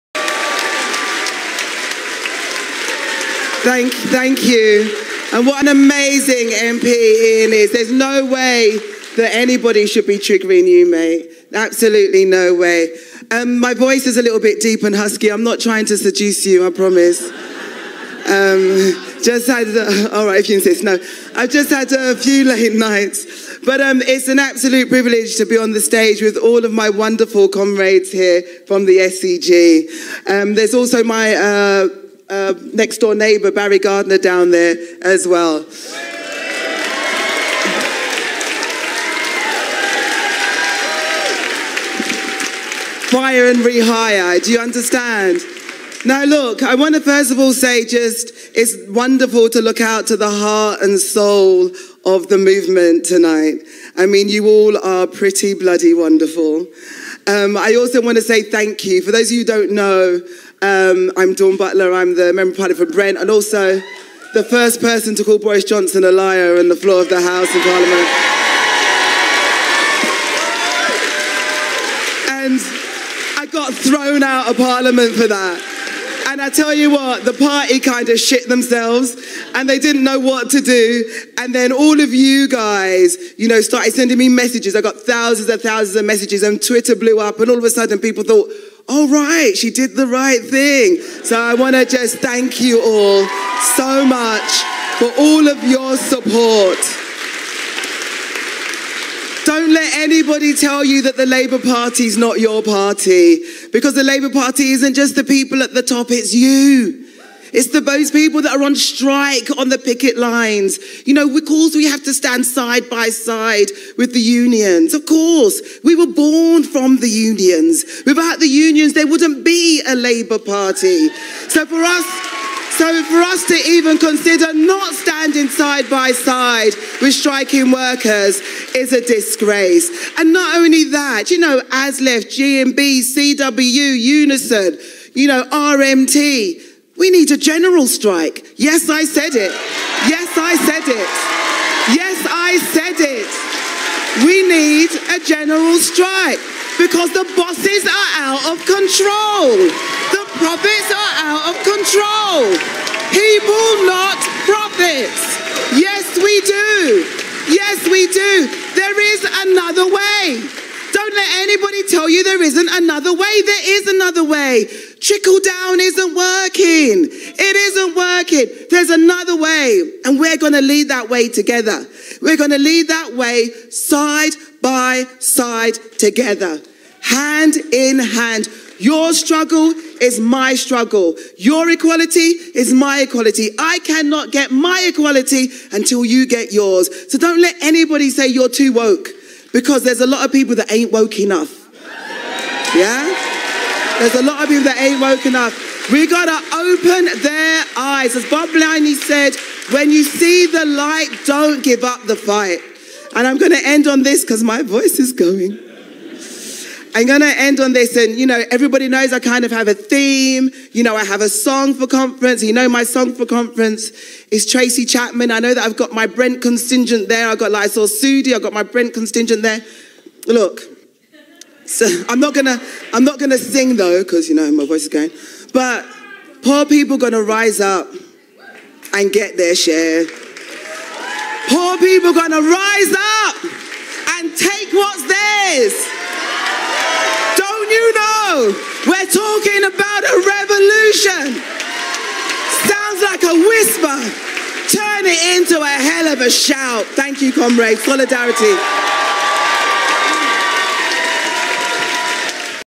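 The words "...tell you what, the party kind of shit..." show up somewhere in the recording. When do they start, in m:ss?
1:16.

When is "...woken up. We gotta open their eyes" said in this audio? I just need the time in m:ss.
3:14.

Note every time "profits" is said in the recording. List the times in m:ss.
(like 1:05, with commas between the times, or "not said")
2:30, 2:34.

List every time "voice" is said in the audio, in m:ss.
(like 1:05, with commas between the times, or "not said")
0:13, 3:24, 3:44.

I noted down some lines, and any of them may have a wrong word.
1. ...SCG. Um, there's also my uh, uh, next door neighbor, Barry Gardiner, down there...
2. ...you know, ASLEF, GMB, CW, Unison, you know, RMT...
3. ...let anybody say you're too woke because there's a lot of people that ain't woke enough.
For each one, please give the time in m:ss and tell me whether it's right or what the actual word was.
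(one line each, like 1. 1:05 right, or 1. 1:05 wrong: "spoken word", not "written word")
1. 0:28 right
2. 2:11 right
3. 3:07 right.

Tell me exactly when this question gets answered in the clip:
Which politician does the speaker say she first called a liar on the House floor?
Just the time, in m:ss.
1:05.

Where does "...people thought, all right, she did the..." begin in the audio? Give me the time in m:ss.
1:27.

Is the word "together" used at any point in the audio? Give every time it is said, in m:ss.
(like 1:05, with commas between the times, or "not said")
2:51, 2:55.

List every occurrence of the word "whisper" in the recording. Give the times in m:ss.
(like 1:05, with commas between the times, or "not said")
4:03.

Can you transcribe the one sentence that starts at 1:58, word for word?
Without the unions, there wouldn't be a Labour Party.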